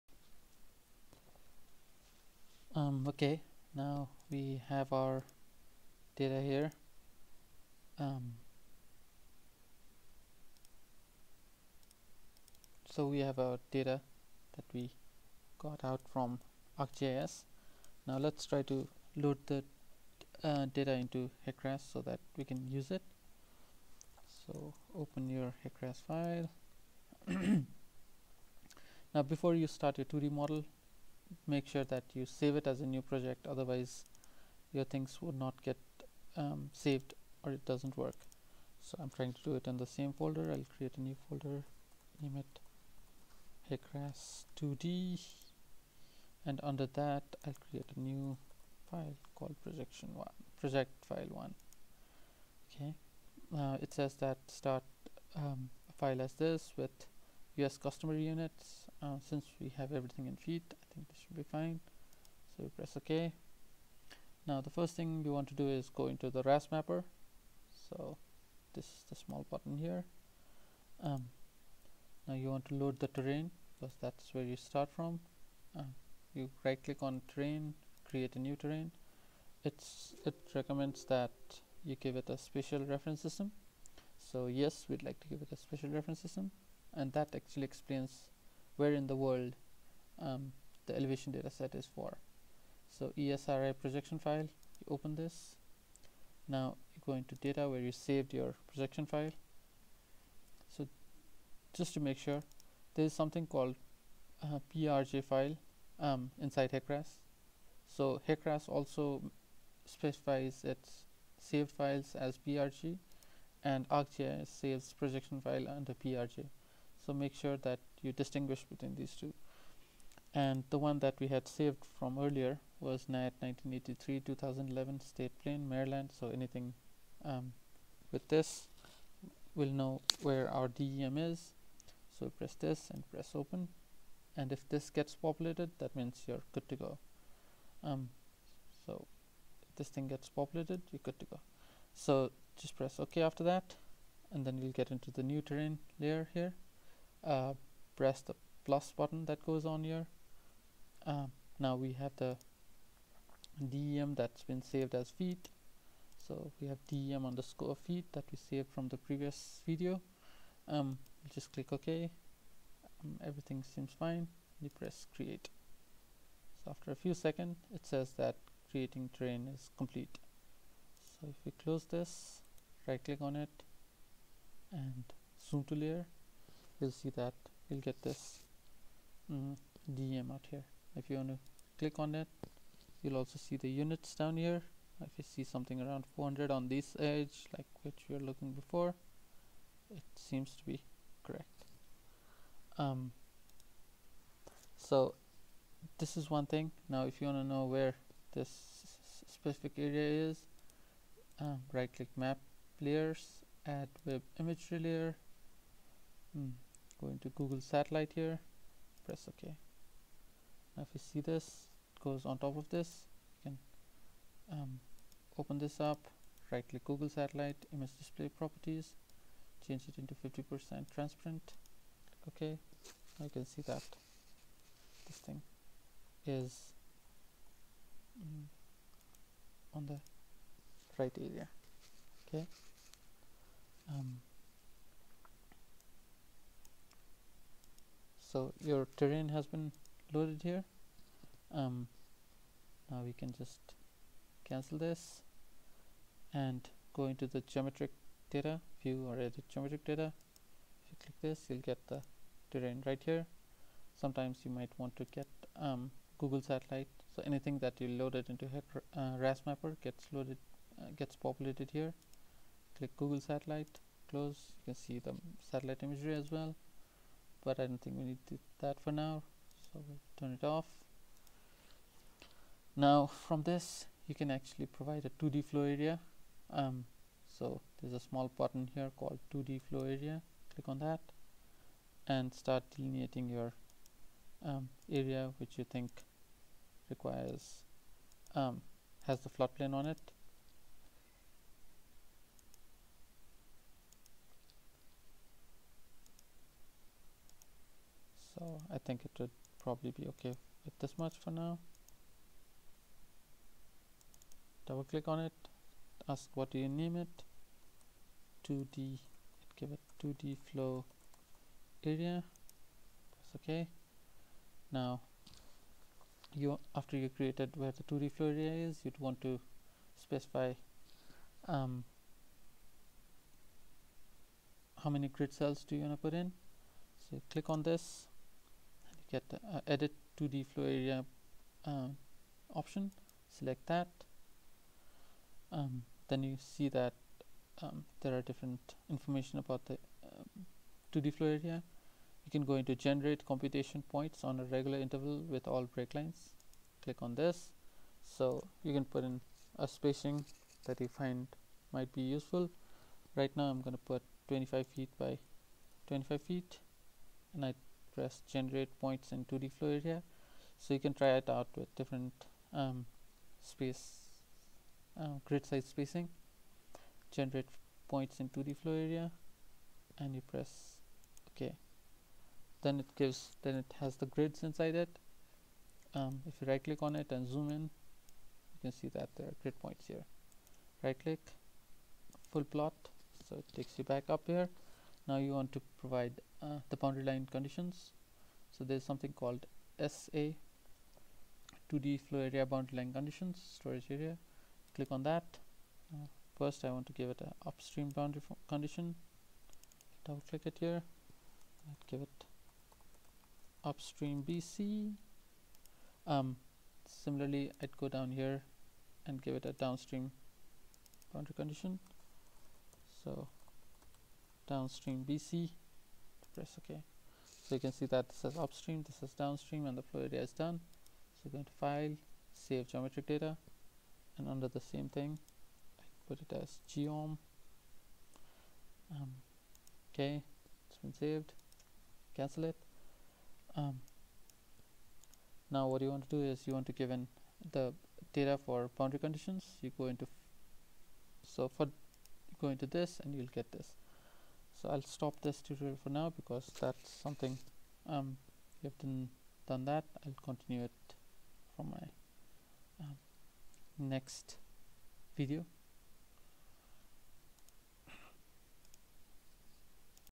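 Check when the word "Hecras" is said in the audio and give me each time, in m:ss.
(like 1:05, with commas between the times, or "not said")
0:21, 0:25.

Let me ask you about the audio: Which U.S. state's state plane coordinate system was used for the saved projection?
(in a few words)
Maryland.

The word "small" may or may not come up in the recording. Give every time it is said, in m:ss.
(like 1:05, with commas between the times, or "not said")
1:09, 4:37.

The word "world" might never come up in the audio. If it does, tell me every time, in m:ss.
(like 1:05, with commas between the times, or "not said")
1:29.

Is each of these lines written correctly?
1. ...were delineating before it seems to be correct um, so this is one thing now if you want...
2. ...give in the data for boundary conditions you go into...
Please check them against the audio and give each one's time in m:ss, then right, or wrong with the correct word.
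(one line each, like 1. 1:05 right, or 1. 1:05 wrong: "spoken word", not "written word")
1. 3:08 wrong: "looking", not "delineating"
2. 7:16 right.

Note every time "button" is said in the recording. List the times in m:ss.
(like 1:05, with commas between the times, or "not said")
1:09, 2:28, 4:38.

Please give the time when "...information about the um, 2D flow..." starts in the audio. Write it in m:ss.
5:38.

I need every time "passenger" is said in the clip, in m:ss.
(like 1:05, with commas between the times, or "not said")
not said.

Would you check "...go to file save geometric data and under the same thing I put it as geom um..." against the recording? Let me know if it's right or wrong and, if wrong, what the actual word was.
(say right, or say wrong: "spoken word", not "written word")
right.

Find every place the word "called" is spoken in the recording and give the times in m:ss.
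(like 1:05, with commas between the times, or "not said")
0:49, 1:43, 4:38, 6:29.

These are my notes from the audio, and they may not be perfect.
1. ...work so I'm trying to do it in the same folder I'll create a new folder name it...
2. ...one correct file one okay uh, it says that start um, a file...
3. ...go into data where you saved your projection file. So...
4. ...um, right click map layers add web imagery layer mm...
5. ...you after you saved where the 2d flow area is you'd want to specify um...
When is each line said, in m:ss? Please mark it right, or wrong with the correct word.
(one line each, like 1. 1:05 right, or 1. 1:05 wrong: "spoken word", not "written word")
1. 0:37 right
2. 0:50 wrong: "project", not "correct"
3. 1:37 right
4. 3:21 right
5. 5:16 wrong: "created", not "saved".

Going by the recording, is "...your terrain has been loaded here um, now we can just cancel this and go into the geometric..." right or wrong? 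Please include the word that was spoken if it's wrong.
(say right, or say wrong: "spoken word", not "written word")
right.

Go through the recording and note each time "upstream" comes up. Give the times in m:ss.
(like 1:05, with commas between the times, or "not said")
6:37, 6:43, 6:58.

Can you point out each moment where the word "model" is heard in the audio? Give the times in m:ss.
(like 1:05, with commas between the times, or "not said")
0:30.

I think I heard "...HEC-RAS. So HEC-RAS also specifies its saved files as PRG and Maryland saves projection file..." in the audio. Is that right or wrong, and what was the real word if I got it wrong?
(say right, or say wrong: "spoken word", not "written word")
wrong: "ArcGIS", not "Maryland".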